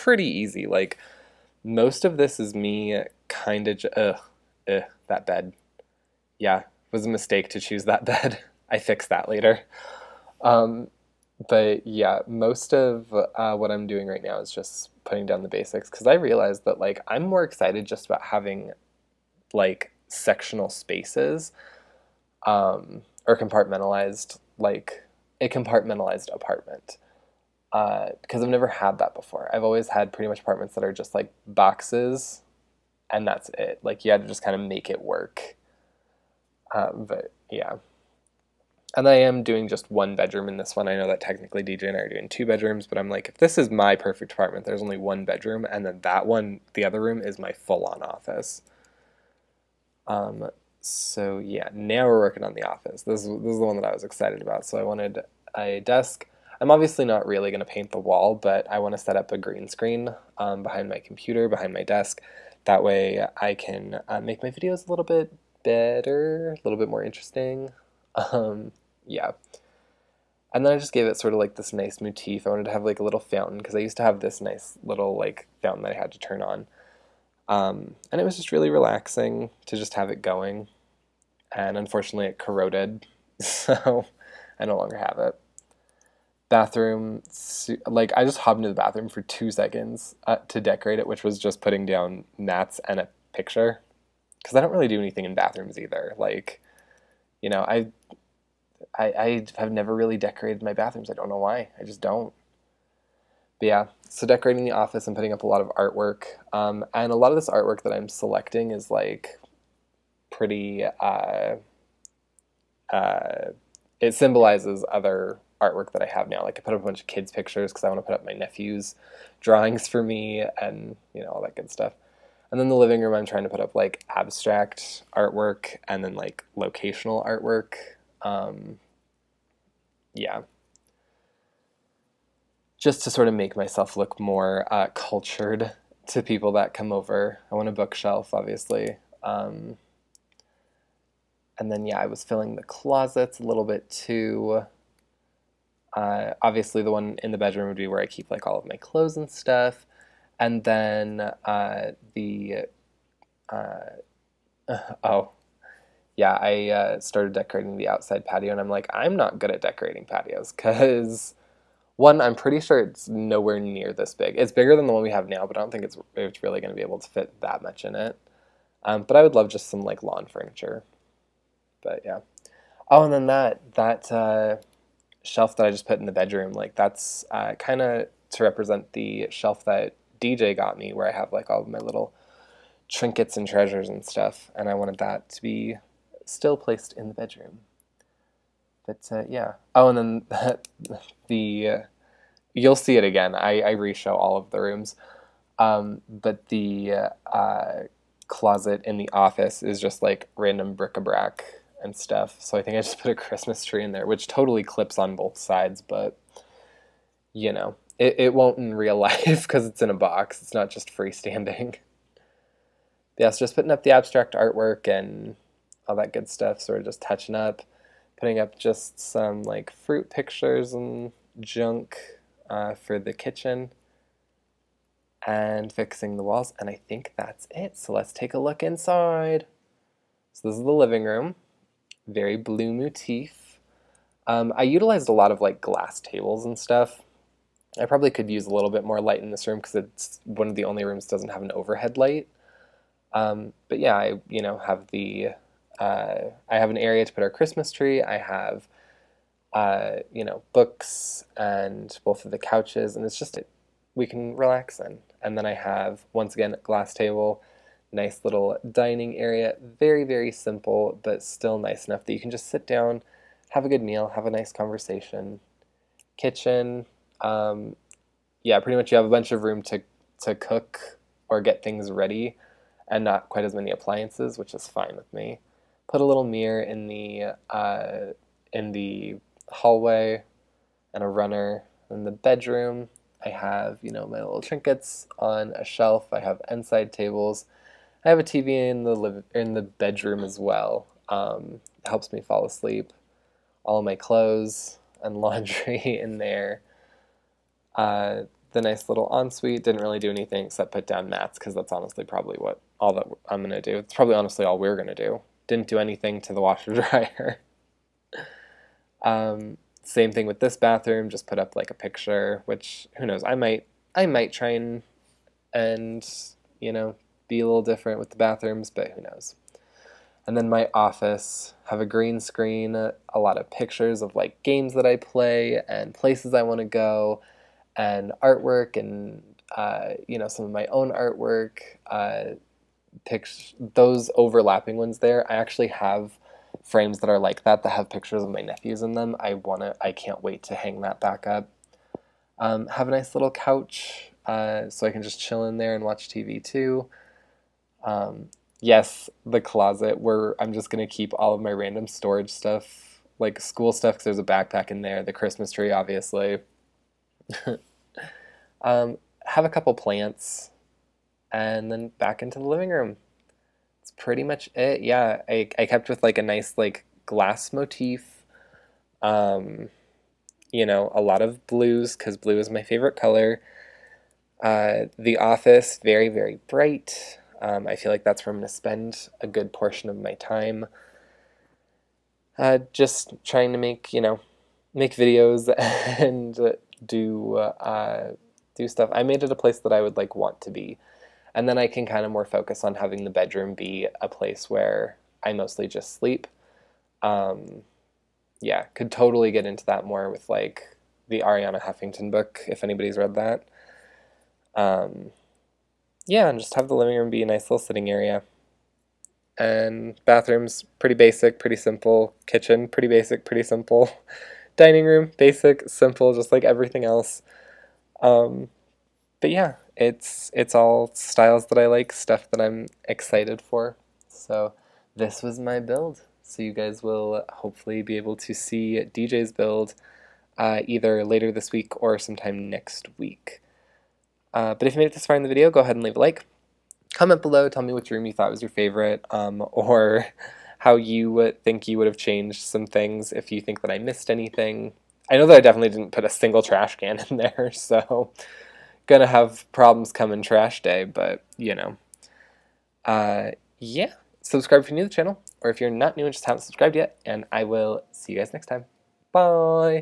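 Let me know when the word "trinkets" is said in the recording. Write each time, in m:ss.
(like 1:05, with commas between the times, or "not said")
3:02, 4:44.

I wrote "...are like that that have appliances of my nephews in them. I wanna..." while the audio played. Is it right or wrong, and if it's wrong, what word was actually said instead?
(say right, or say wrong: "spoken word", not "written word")
wrong: "pictures", not "appliances".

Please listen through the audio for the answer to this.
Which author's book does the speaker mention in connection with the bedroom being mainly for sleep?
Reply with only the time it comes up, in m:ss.
6:41.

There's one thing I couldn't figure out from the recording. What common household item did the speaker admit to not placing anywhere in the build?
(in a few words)
trash can.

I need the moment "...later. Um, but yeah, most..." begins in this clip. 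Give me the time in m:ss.
0:09.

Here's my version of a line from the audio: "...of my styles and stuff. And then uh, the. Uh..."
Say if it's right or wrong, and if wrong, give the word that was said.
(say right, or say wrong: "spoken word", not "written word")
wrong: "clothes", not "styles".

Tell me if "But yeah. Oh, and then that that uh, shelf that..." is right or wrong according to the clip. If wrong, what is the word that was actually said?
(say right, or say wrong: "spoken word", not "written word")
right.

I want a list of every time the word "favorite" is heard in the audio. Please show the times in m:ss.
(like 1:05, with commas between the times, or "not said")
6:12, 7:18.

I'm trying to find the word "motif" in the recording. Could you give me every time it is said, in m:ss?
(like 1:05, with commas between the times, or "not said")
1:11, 3:52, 6:07.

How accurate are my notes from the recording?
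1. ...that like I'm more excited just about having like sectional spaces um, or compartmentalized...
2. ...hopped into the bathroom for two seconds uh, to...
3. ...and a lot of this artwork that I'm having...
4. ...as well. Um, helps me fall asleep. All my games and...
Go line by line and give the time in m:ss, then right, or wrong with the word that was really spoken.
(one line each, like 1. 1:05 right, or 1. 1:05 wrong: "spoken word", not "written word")
1. 0:16 right
2. 1:28 right
3. 1:46 wrong: "selecting", not "having"
4. 4:50 wrong: "clothes", not "games".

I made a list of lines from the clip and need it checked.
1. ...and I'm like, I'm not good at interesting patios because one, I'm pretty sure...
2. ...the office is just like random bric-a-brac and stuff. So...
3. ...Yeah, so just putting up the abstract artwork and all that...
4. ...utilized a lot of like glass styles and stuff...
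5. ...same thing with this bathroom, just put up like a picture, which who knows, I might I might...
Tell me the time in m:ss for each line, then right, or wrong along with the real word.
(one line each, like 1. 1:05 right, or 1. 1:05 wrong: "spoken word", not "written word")
1. 2:38 wrong: "decorating", not "interesting"
2. 3:18 right
3. 3:33 right
4. 3:54 wrong: "tables", not "styles"
5. 5:09 right.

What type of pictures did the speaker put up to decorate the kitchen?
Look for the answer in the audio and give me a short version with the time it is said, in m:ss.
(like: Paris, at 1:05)
fruit pictures, at 3:39.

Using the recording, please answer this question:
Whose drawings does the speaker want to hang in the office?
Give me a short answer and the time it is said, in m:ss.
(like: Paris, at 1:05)
nephew's, at 1:58.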